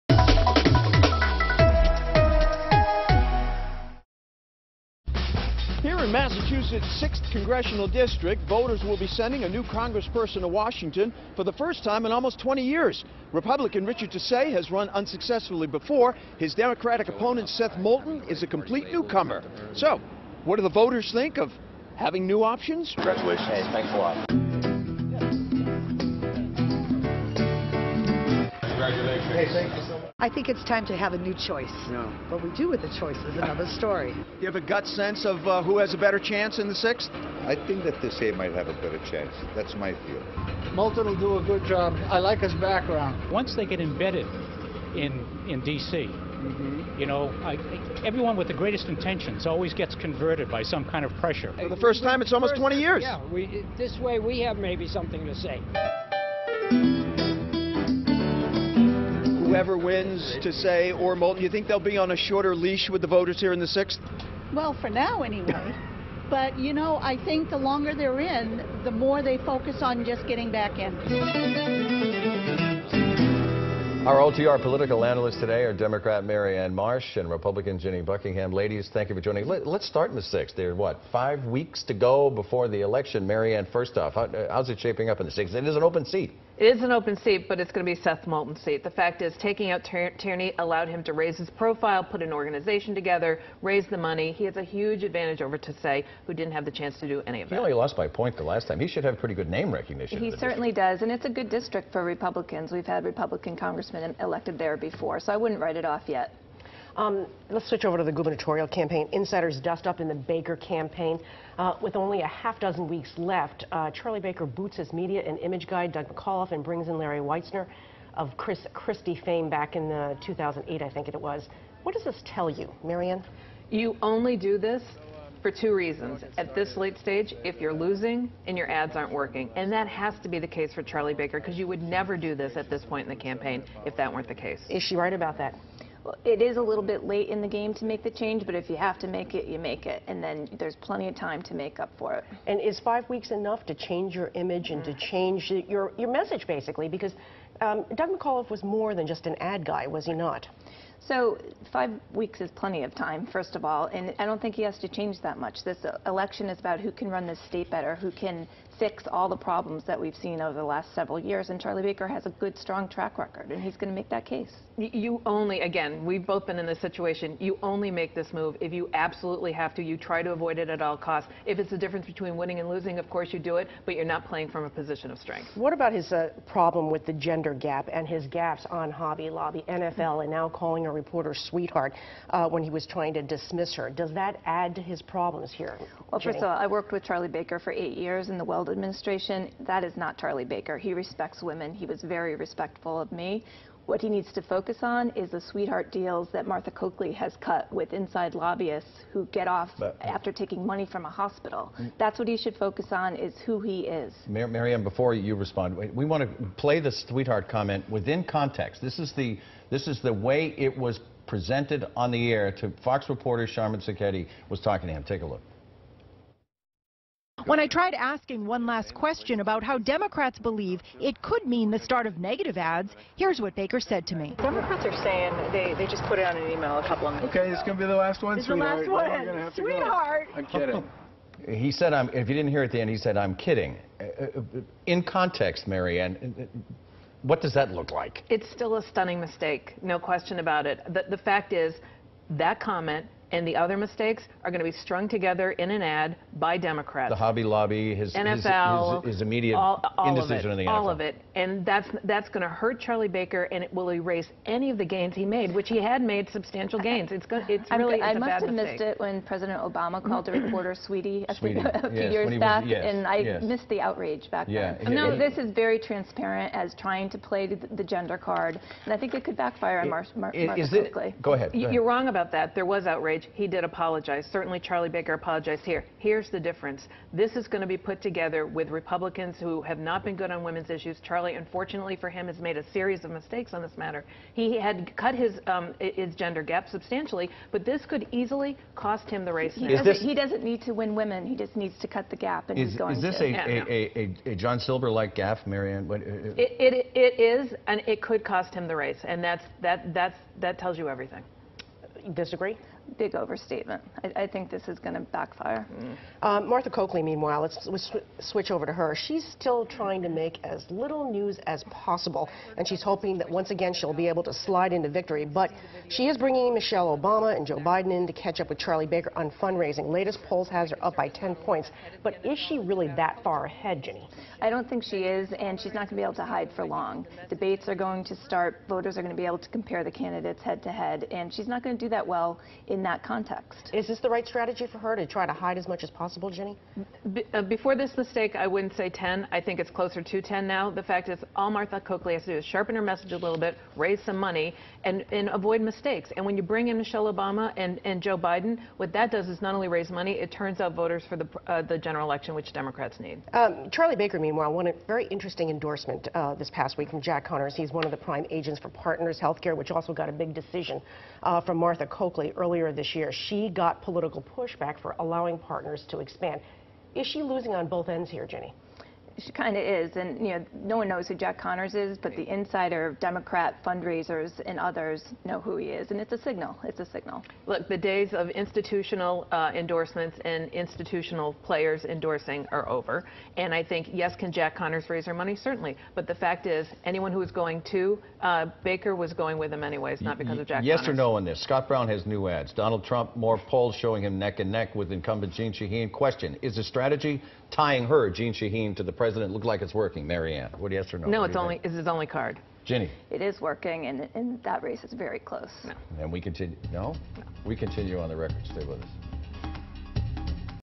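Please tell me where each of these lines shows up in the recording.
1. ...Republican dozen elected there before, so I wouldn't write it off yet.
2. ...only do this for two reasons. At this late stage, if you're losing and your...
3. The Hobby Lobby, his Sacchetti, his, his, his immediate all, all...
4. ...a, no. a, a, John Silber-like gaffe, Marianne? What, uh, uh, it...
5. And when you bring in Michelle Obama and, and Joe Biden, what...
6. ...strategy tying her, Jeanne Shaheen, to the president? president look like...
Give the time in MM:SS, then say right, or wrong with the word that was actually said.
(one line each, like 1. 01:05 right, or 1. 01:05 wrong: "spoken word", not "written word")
1. 01:43 wrong: "congressmen", not "dozen"
2. 02:04 right
3. 04:07 wrong: "NFL", not "Sacchetti"
4. 04:53 right
5. 05:46 right
6. 06:36 right.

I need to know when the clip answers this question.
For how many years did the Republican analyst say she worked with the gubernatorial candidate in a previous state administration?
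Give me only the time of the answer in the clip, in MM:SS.
03:07.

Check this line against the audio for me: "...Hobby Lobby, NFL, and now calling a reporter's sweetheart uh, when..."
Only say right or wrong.
right.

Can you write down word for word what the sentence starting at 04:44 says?
He had cut his um, his gender gap substantially, but this could easily cost him the race.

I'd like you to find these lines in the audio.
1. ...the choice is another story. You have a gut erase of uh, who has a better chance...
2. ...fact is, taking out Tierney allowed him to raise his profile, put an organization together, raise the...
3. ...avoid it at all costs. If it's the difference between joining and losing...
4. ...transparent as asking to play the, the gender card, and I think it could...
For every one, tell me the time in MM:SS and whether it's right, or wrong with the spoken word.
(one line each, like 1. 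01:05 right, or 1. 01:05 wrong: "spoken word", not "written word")
1. 00:32 wrong: "sense", not "erase"
2. 01:28 right
3. 02:50 wrong: "winning", not "joining"
4. 04:25 wrong: "trying", not "asking".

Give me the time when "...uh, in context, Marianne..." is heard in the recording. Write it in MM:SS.
03:54.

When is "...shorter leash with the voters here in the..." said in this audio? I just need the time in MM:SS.
01:02.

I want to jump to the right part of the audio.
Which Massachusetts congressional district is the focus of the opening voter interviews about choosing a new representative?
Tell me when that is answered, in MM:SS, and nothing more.
00:07.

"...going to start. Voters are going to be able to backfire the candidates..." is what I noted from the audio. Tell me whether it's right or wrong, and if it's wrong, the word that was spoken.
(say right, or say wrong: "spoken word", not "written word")
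wrong: "compare", not "backfire".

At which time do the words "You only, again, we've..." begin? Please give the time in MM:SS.
02:44.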